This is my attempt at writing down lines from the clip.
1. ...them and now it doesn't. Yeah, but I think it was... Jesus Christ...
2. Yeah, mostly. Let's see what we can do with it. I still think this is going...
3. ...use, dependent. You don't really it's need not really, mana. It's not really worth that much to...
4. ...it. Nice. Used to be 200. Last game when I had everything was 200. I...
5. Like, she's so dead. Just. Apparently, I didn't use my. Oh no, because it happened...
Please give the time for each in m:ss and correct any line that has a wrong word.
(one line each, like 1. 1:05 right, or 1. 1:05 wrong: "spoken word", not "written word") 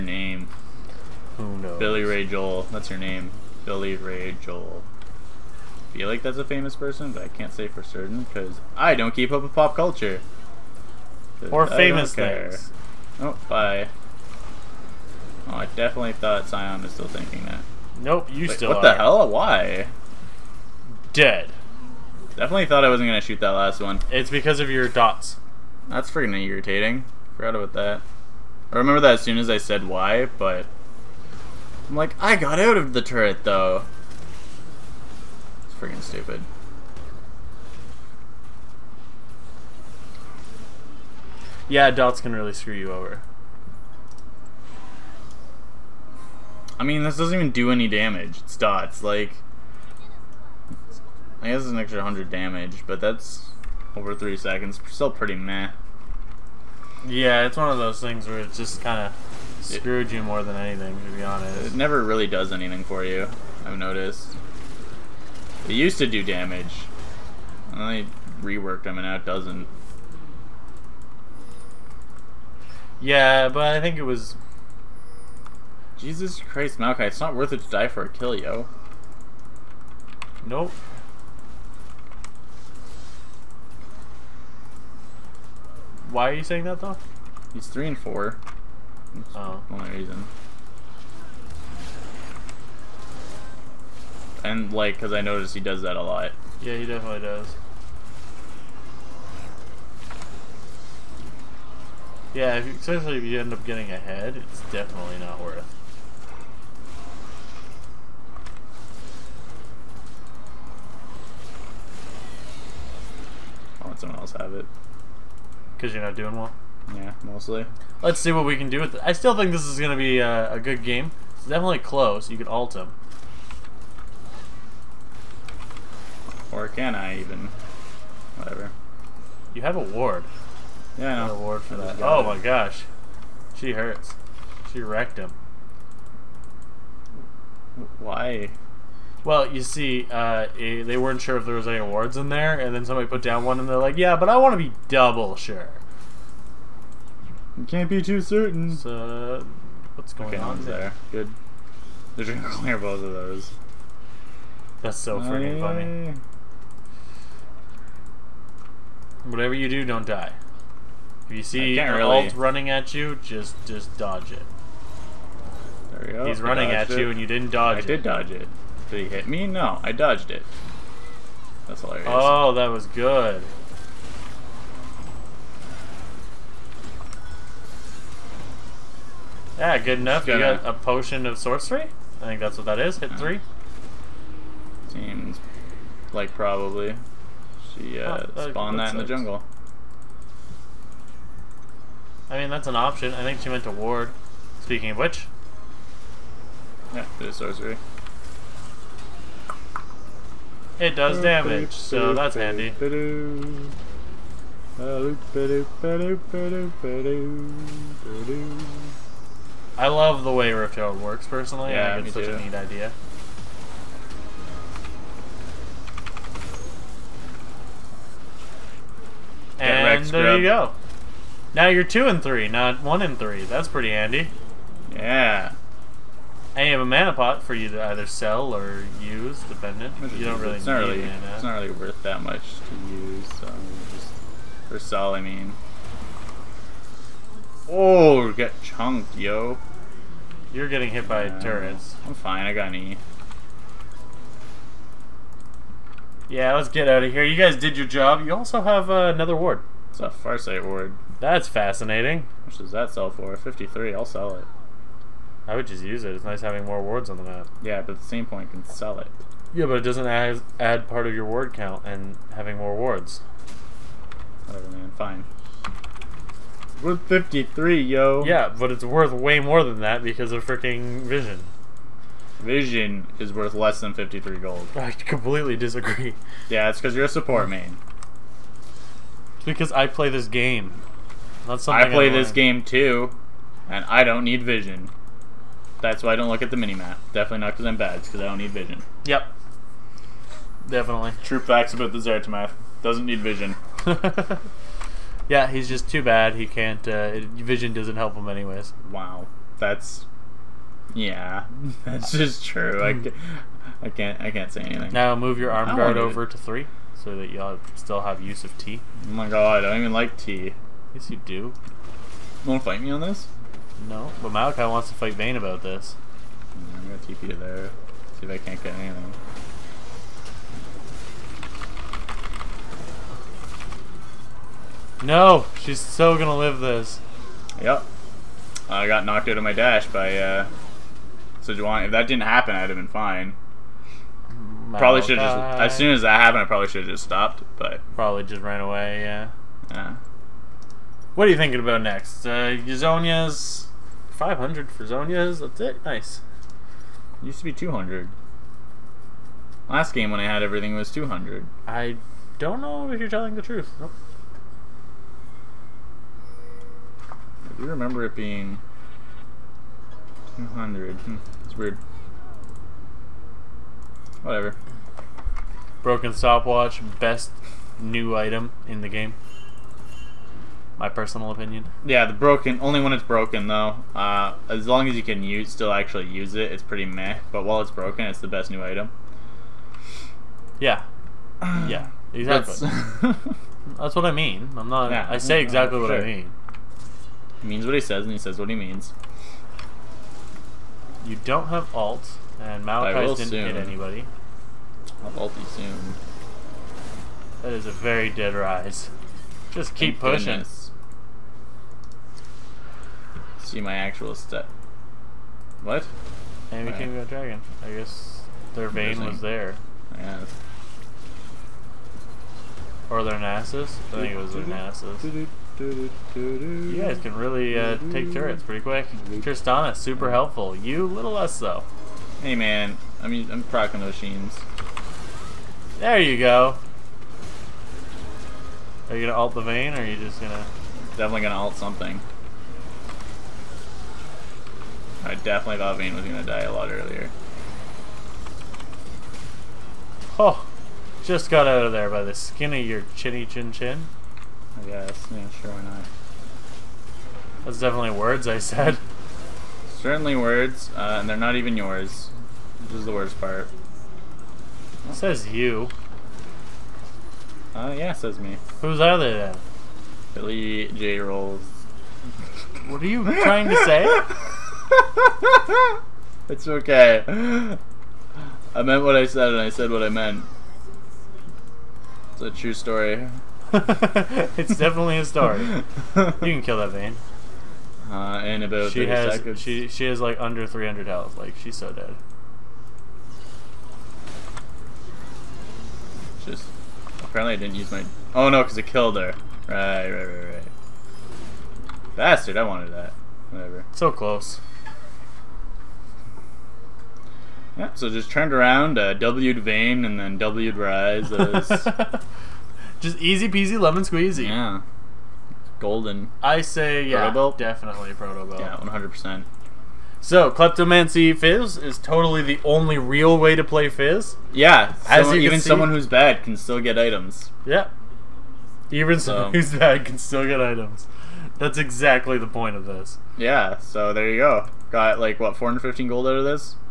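1. 1:08 right
2. 1:56 right
3. 3:49 right
4. 5:45 right
5. 8:01 wrong: "killed", not "happened".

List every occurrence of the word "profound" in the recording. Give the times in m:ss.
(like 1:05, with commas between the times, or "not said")
not said.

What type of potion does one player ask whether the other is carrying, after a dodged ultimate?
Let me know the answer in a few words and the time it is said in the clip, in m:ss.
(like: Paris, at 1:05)
potion of sorcery, at 3:00.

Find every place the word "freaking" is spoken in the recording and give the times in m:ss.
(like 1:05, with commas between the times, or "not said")
0:26, 0:35, 2:35, 4:30.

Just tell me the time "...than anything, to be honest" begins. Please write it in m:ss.
1:00.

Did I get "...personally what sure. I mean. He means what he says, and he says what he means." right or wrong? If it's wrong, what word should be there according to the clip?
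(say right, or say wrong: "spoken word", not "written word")
wrong: "exactly", not "personally".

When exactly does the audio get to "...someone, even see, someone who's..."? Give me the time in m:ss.
8:35.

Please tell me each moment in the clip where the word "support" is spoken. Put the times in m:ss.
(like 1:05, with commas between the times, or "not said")
4:37.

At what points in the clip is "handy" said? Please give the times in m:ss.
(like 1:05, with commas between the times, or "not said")
3:22, 3:43.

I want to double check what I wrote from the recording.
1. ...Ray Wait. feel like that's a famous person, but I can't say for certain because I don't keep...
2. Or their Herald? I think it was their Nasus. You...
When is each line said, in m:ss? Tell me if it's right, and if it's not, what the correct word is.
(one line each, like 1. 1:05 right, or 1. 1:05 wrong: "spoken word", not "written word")
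1. 0:03 wrong: "Joel", not "Wait"
2. 6:52 wrong: "Nasus", not "Herald".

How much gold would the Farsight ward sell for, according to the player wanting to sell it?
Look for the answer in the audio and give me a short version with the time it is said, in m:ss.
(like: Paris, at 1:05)
53, at 4:13.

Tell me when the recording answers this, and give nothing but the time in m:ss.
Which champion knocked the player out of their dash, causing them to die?
5:31.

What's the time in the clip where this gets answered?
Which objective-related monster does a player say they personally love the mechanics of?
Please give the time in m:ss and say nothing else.
3:22.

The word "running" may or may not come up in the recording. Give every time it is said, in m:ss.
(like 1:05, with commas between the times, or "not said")
2:42, 2:46.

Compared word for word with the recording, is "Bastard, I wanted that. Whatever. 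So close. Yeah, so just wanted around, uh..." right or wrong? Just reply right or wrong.
wrong.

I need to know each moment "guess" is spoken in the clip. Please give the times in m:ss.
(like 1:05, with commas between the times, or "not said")
0:51, 6:47, 7:24.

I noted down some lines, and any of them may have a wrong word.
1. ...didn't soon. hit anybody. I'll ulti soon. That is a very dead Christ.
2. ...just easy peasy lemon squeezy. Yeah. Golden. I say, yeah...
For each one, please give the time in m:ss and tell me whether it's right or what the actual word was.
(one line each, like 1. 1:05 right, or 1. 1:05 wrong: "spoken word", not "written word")
1. 6:33 wrong: "Ryze", not "Christ"
2. 8:22 right.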